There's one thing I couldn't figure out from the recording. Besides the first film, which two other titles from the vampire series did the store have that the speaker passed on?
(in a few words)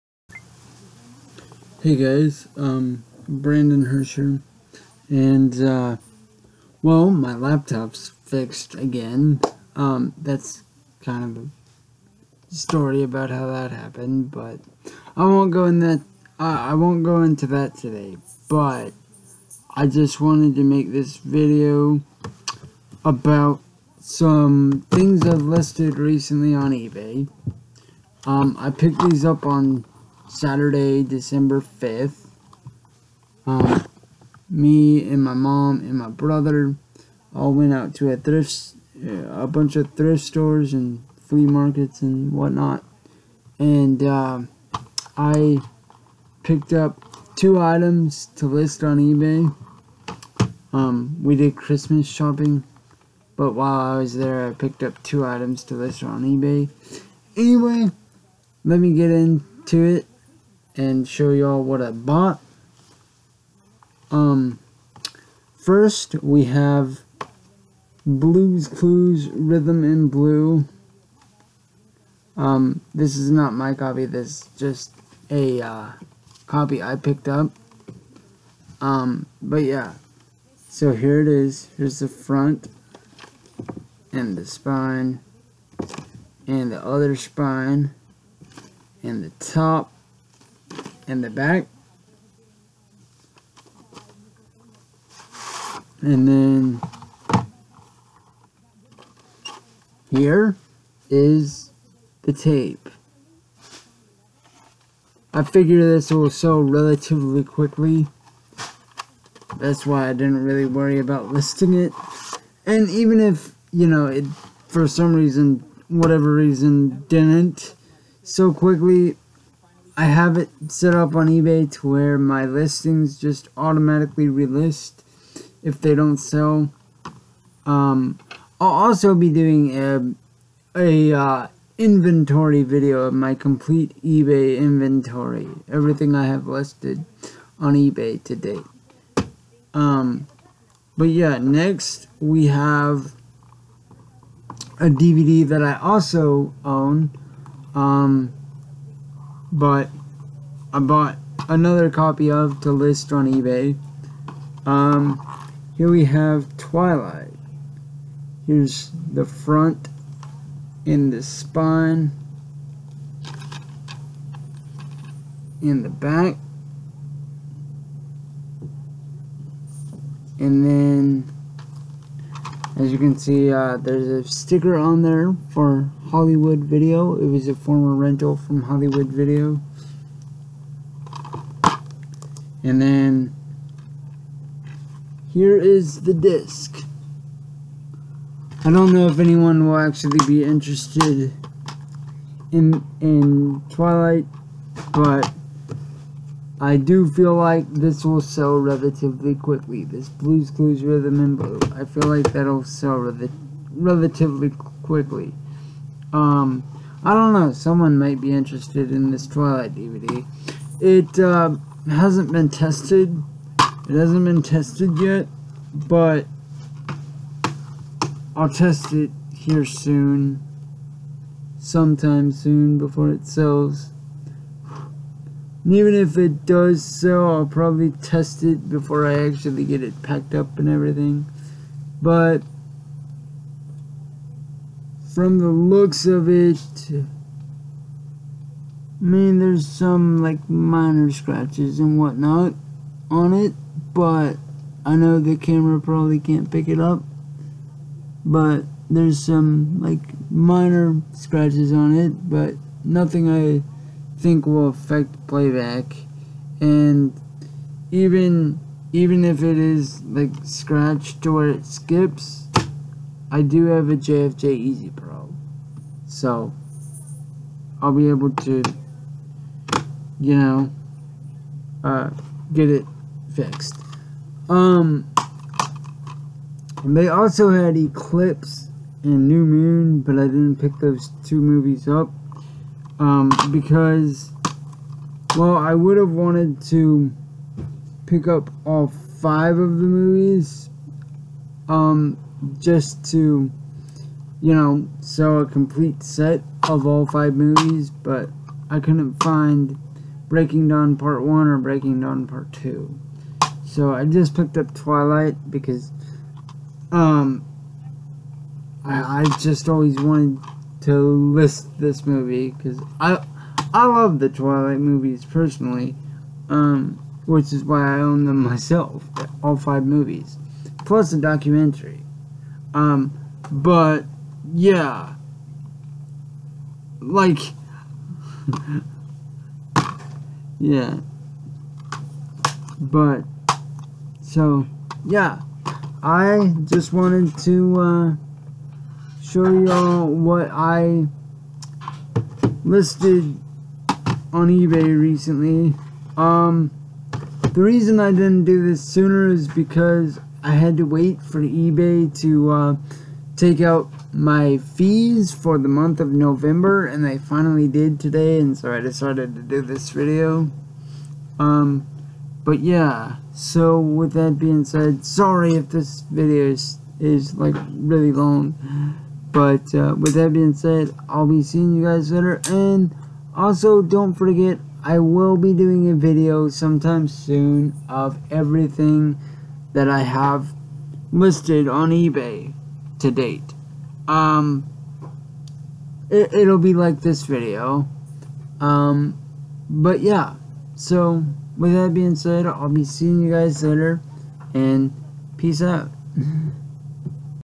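Eclipse and New Moon.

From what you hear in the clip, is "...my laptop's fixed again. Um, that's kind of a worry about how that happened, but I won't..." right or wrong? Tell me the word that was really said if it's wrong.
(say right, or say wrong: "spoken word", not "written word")
wrong: "story", not "worry".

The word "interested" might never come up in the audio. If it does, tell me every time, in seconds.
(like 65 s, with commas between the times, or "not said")
190 s, 208 s.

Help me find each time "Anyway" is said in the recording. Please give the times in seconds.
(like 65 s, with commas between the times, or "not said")
57 s.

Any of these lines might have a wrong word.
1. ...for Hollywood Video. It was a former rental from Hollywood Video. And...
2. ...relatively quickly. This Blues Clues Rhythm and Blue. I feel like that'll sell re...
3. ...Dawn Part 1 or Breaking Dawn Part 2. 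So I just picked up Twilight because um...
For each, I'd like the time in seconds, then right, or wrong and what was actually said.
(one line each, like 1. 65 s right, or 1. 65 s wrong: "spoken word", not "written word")
1. 175 s right
2. 198 s right
3. 300 s right.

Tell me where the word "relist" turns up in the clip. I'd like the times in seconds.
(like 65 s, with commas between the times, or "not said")
124 s.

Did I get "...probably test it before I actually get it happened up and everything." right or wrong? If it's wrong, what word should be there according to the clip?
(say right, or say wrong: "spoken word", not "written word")
wrong: "packed", not "happened".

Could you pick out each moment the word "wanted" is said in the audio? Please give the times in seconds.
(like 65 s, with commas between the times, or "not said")
20 s, 286 s, 309 s, 336 s.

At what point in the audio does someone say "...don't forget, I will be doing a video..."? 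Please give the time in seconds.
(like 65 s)
373 s.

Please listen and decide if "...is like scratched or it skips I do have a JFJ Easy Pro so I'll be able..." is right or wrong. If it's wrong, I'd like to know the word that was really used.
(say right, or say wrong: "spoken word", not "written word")
right.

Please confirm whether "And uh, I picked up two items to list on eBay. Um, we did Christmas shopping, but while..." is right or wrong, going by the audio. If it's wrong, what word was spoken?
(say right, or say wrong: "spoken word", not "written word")
right.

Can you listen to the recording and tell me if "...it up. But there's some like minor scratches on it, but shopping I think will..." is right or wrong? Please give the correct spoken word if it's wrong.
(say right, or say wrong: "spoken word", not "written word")
wrong: "nothing", not "shopping".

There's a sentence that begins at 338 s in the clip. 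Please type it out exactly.
Uh, show y'all what I listed on eBay recently.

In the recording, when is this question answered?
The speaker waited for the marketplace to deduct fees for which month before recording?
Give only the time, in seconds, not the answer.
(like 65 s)
356 s.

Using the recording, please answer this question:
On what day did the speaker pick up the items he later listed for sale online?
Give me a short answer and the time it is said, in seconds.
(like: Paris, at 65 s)
Saturday, December 5th, at 30 s.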